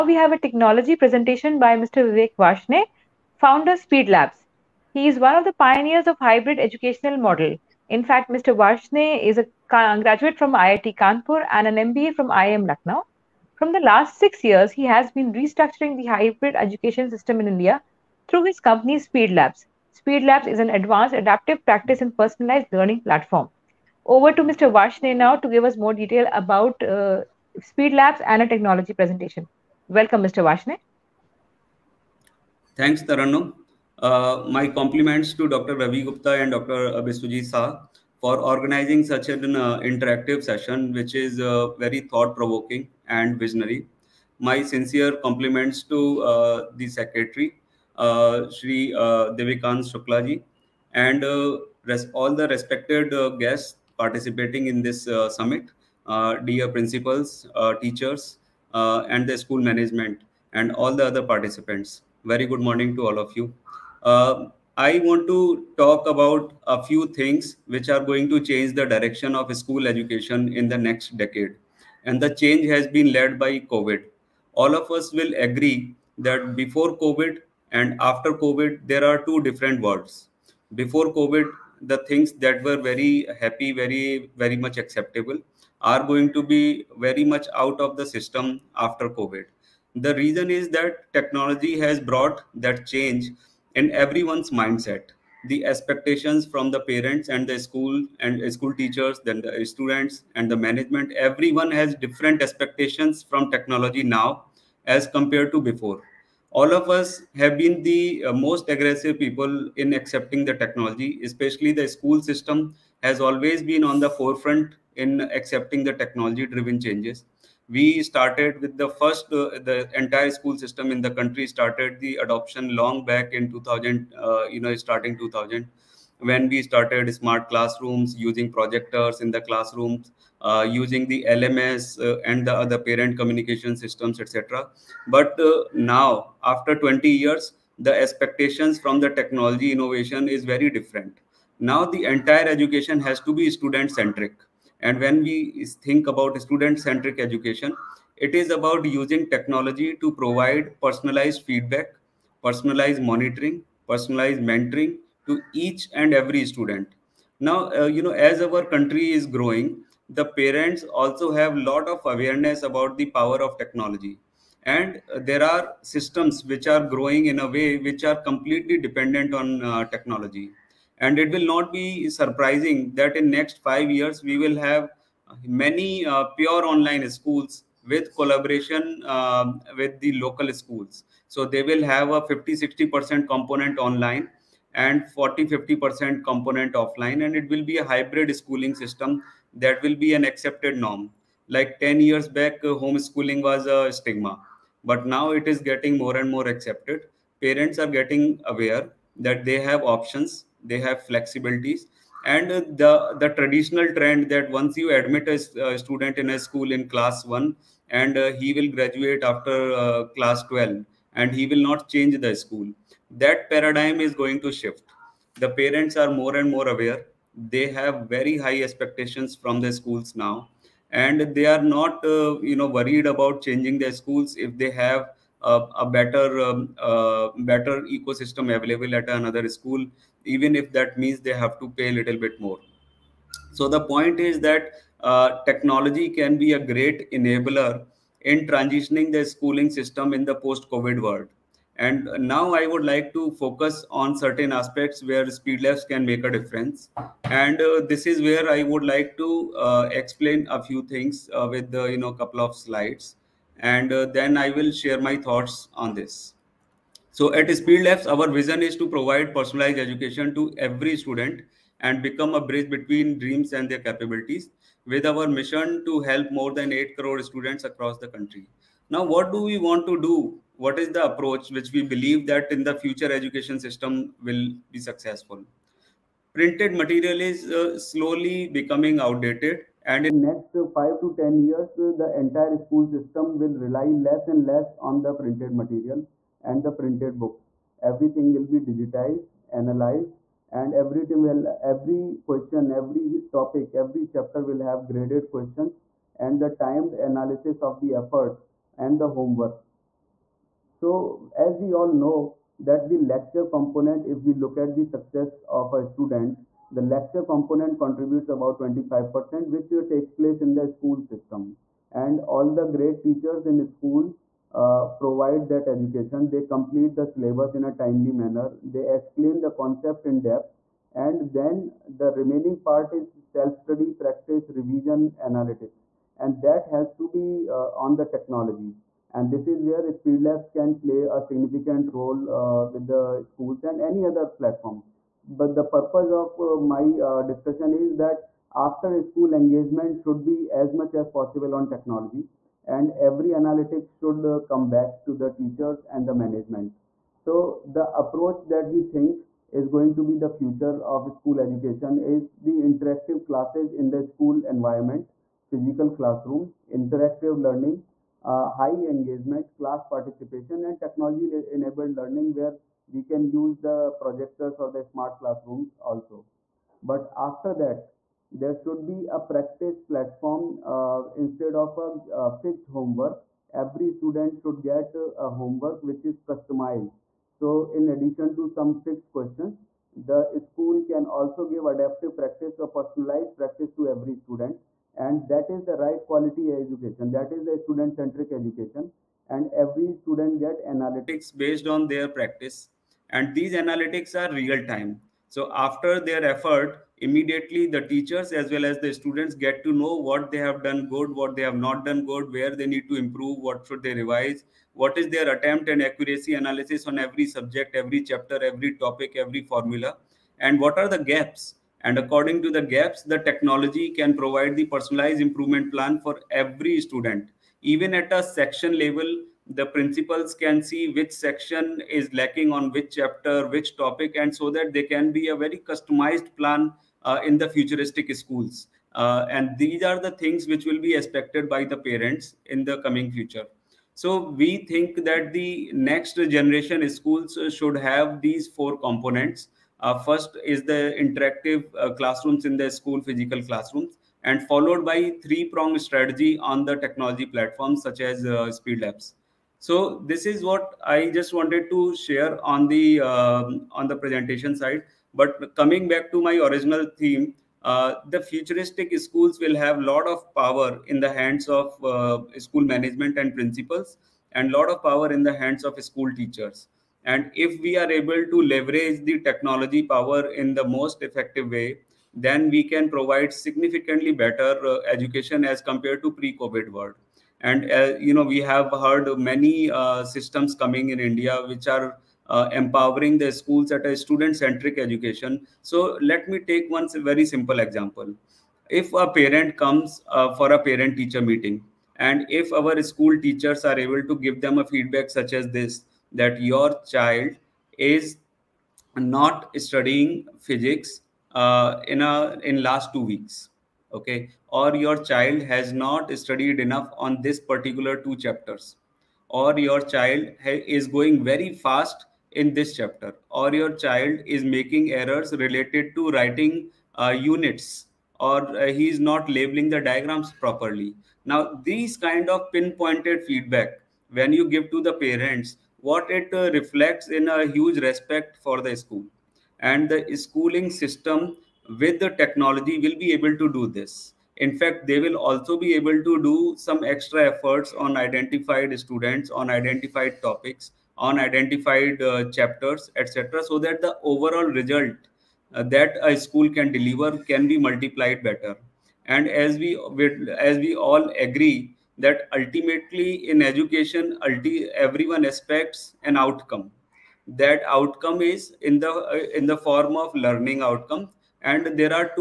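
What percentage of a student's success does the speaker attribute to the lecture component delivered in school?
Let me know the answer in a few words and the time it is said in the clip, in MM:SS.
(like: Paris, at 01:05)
25%, at 05:08.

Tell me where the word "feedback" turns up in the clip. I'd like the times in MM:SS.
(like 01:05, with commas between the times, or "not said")
02:31, 08:14, 08:43.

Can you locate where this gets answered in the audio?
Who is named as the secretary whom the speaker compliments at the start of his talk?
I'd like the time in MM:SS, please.
00:49.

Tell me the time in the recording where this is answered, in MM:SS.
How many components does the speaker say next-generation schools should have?
07:18.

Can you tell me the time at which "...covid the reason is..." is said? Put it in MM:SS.
01:29.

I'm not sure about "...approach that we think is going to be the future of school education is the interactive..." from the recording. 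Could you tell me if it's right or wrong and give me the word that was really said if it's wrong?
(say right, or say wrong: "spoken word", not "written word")
right.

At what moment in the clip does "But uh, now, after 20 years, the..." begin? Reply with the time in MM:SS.
02:15.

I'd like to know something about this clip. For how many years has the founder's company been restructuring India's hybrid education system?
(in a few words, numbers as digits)
6.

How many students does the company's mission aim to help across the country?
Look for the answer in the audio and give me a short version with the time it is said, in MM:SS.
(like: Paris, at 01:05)
8 crore, at 04:26.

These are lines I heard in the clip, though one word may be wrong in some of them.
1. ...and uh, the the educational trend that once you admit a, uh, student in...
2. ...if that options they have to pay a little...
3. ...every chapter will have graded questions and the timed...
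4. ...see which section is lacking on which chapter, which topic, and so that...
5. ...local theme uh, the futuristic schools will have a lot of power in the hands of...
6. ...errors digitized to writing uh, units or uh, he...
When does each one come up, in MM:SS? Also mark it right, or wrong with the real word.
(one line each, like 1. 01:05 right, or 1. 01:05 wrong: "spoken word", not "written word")
1. 03:22 wrong: "traditional", not "educational"
2. 03:50 wrong: "means", not "options"
3. 04:53 right
4. 07:00 right
5. 07:36 wrong: "original", not "local"
6. 08:34 wrong: "related", not "digitized".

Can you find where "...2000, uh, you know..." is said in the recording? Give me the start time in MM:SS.
02:03.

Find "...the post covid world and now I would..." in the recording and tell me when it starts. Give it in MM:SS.
04:00.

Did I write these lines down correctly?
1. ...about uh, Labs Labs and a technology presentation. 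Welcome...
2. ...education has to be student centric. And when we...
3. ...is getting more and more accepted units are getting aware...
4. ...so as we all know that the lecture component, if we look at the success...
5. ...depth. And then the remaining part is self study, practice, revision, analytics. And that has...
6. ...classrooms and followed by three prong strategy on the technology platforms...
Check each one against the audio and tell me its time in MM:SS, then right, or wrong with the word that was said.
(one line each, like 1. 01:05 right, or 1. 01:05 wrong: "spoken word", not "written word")
1. 00:26 wrong: "Speed", not "Labs"
2. 02:22 right
3. 03:15 wrong: "parents", not "units"
4. 05:00 right
5. 05:20 right
6. 07:23 right.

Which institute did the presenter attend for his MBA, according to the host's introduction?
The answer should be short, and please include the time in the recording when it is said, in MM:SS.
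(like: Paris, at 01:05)
IIM Lucknow, at 00:12.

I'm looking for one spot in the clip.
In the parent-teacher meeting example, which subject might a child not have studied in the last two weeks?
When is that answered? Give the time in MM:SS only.
08:20.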